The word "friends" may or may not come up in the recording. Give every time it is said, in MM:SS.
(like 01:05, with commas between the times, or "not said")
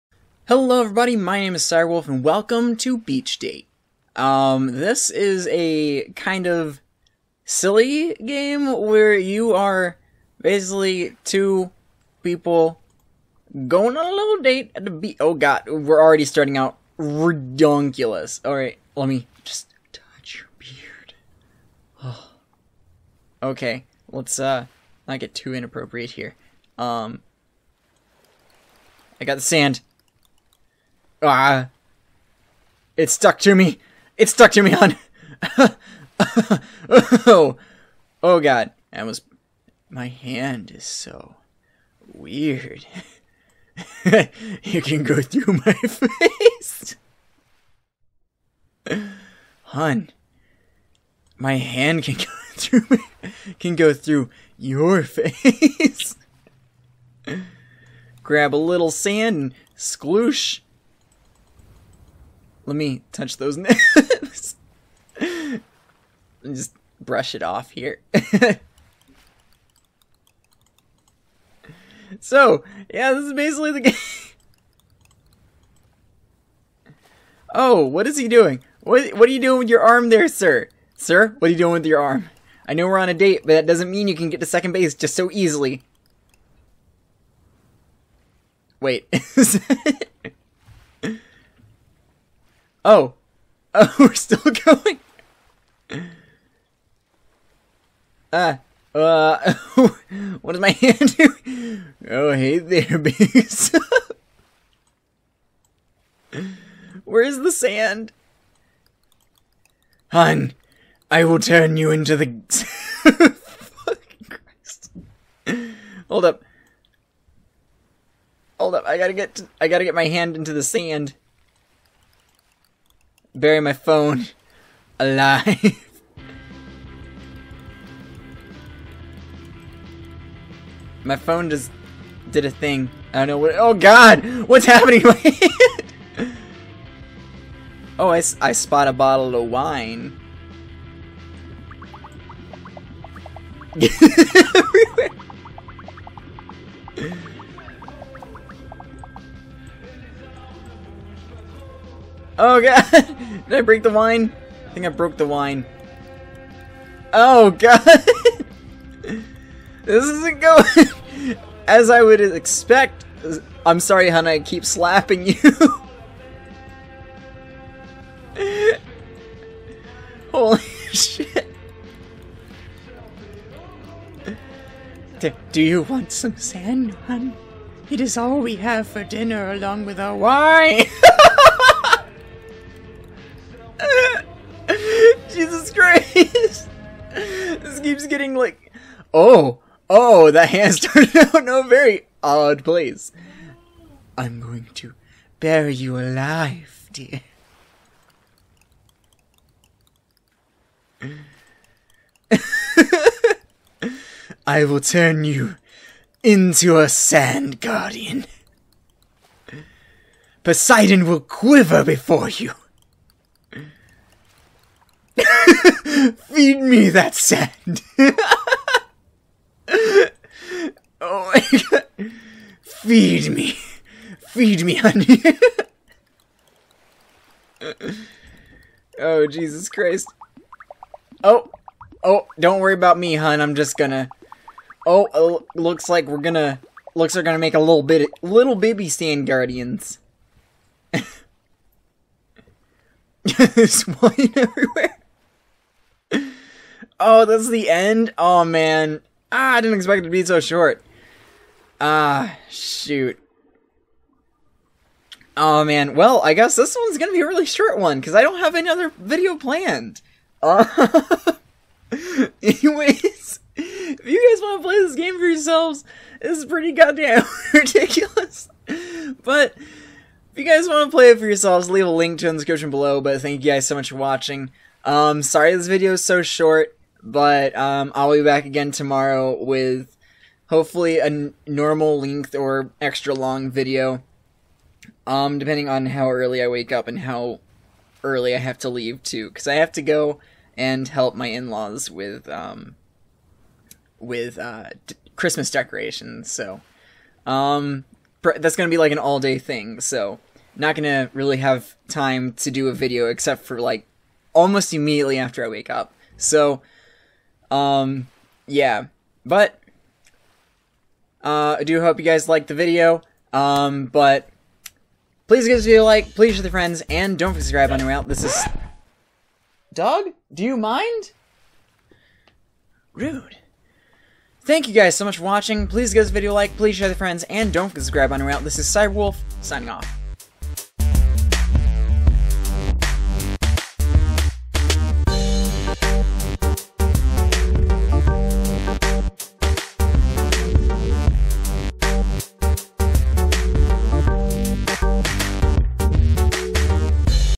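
05:16, 05:26.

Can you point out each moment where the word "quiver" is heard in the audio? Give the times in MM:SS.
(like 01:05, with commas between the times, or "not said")
03:31.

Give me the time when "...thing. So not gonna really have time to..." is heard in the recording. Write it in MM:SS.
04:59.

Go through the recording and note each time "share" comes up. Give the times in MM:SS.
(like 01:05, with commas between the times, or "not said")
05:16, 05:26.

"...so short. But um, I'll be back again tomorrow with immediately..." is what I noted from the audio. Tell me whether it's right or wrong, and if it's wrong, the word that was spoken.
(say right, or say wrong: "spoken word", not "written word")
wrong: "hopefully", not "immediately".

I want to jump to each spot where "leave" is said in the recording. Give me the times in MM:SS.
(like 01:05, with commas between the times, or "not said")
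04:31, 04:48.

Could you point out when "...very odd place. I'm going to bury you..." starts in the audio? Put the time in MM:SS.
03:11.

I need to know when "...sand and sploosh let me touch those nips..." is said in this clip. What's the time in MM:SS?
00:58.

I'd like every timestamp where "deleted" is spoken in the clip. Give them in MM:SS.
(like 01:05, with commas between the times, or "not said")
not said.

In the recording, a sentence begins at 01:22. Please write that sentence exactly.
I know we're on a date, but that doesn't mean you can get to second base just so easily.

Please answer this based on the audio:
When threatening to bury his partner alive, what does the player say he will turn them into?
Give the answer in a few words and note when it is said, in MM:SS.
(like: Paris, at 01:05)
A sand guardian, at 03:26.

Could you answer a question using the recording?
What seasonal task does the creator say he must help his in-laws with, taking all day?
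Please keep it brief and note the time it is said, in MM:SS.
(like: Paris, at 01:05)
Christmas decorations, at 04:55.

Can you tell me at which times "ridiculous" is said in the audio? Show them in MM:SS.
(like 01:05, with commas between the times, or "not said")
04:27.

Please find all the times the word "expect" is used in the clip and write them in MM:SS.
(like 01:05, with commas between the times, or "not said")
02:42, 04:09.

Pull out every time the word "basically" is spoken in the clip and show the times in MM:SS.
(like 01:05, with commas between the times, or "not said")
00:10, 01:13.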